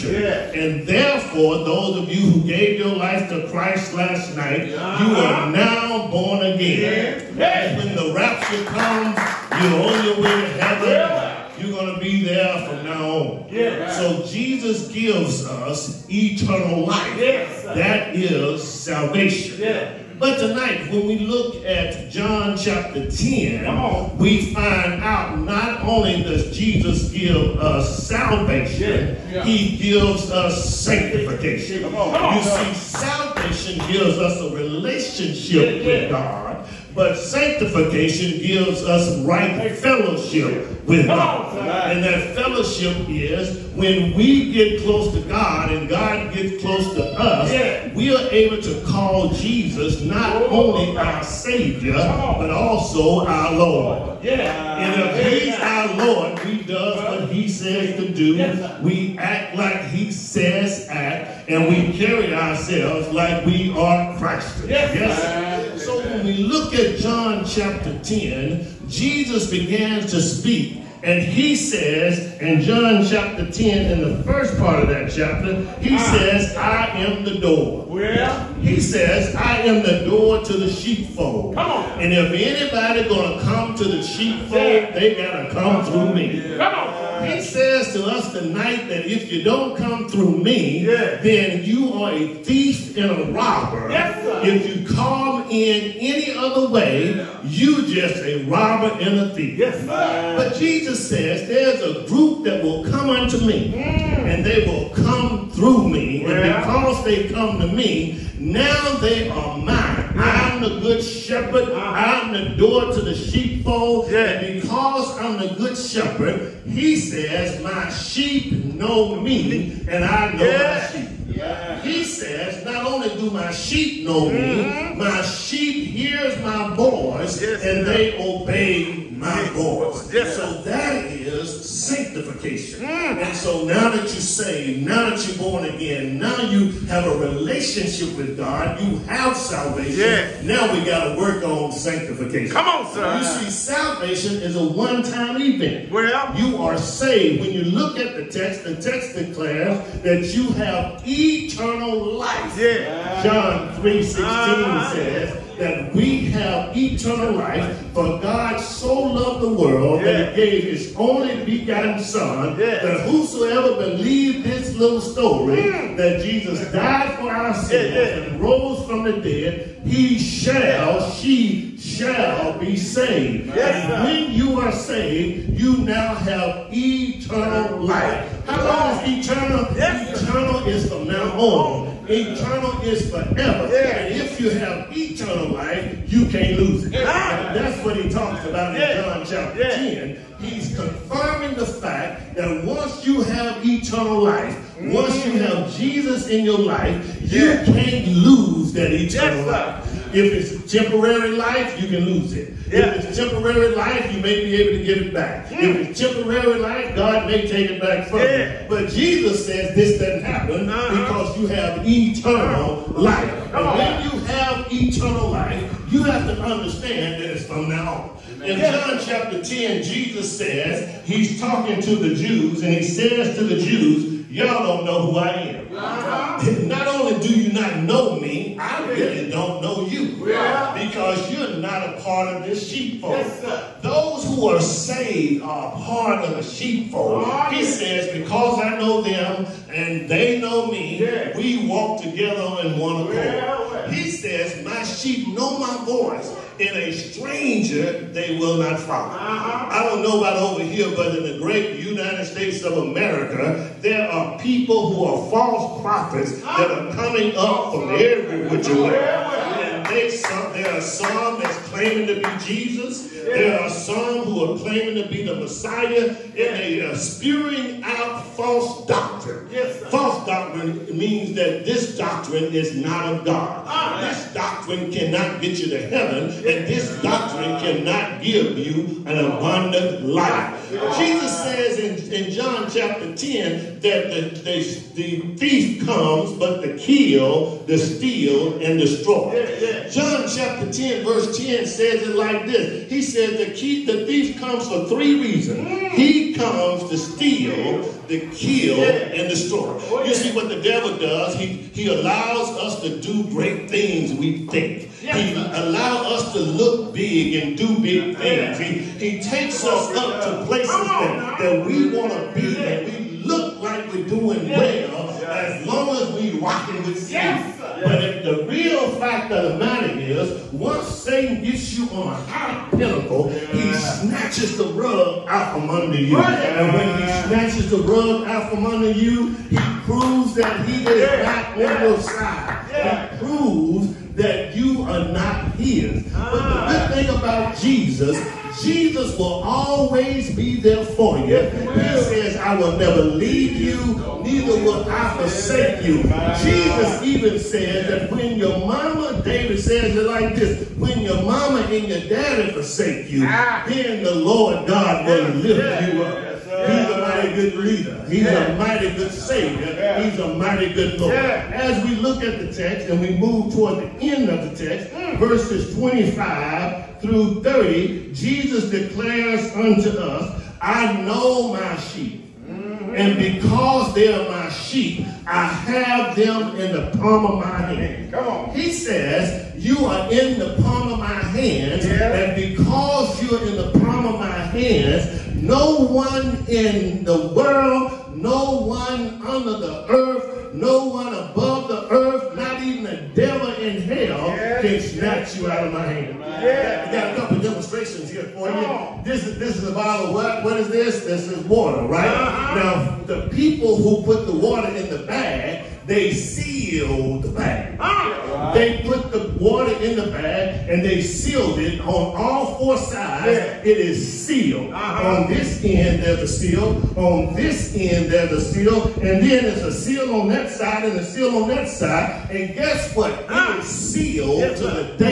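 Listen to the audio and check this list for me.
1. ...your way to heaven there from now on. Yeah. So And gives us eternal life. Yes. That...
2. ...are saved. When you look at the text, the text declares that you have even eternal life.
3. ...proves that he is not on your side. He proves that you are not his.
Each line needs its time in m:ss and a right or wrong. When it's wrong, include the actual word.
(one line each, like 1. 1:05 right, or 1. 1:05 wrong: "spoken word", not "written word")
1. 0:10 wrong: "Jesus", not "And"
2. 2:26 right
3. 5:29 right.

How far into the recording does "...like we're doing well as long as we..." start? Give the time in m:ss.
5:13.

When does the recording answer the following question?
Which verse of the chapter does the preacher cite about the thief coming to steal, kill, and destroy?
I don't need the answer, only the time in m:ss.
4:51.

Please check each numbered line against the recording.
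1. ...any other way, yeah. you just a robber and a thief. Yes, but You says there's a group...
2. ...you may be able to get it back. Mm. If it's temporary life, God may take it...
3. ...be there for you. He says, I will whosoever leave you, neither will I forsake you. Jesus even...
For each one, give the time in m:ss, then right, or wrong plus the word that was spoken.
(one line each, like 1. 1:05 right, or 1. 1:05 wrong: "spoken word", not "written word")
1. 1:35 wrong: "Jesus", not "You"
2. 3:24 right
3. 5:40 wrong: "never", not "whosoever".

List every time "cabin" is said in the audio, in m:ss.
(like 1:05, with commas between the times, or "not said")
not said.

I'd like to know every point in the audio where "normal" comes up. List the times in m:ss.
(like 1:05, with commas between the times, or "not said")
not said.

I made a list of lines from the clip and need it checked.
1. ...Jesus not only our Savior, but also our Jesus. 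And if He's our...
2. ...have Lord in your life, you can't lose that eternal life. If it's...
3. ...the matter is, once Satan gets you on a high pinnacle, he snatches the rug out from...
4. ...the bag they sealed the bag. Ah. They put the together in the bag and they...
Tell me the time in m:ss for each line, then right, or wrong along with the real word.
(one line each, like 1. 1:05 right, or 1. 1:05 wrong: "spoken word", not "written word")
1. 0:49 wrong: "Lord", not "Jesus"
2. 3:15 wrong: "Jesus", not "Lord"
3. 5:19 right
4. 6:44 wrong: "water", not "together".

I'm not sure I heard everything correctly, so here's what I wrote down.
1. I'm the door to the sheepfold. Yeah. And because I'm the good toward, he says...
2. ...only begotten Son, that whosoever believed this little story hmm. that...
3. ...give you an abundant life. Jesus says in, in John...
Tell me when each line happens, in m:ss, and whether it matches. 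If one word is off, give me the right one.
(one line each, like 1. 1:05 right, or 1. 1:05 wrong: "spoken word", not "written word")
1. 1:52 wrong: "shepherd", not "toward"
2. 2:40 right
3. 4:38 right.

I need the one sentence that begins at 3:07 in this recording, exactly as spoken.
That's what he talks about in John chapter 10.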